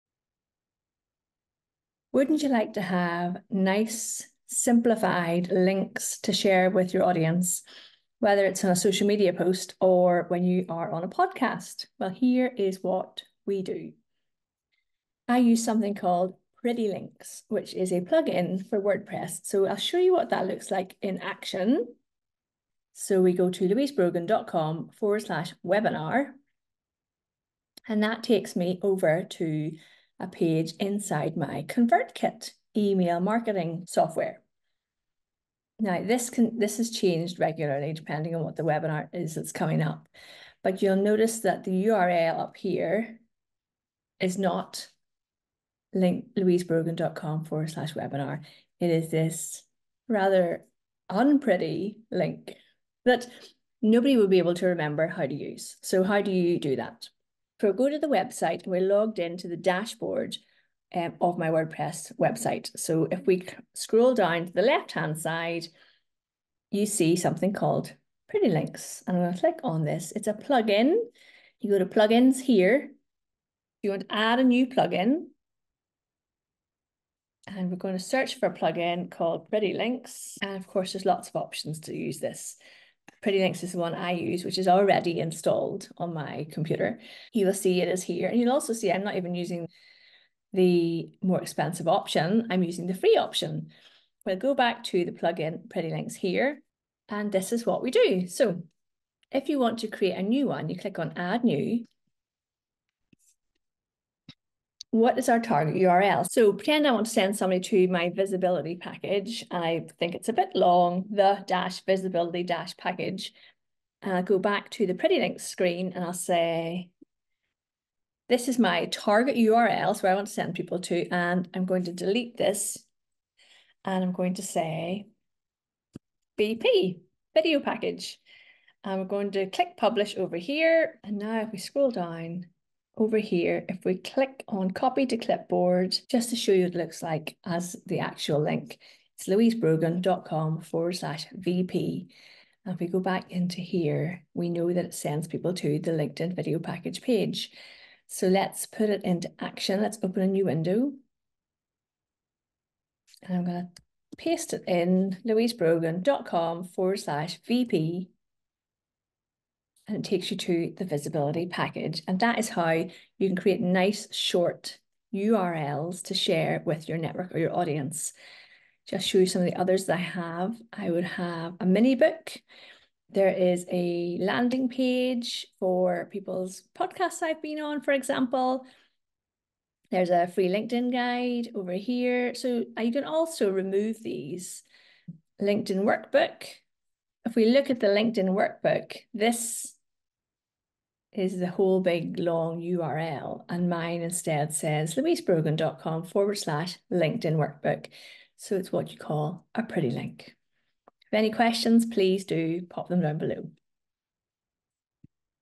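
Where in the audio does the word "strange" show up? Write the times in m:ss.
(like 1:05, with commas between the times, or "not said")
not said.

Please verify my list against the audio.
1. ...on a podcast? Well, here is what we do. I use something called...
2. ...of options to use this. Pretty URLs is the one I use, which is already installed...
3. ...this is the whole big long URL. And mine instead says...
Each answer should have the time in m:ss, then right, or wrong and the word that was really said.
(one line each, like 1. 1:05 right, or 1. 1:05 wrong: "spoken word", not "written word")
1. 0:10 right
2. 1:21 wrong: "Links", not "URLs"
3. 3:09 right.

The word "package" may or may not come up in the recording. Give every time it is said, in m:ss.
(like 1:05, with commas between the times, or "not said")
1:48, 1:52, 2:07, 2:26, 2:41.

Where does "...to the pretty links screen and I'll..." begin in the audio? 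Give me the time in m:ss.
1:54.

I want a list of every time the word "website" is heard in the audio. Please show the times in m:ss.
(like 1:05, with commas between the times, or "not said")
0:58, 1:02.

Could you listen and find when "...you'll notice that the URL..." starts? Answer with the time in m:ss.
0:40.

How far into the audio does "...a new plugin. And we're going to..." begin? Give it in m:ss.
1:14.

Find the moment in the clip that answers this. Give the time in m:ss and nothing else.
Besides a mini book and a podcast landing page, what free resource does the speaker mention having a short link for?
3:00.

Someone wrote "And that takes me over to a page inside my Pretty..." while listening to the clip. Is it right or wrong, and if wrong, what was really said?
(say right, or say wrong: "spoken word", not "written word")
wrong: "ConvertKit", not "Pretty".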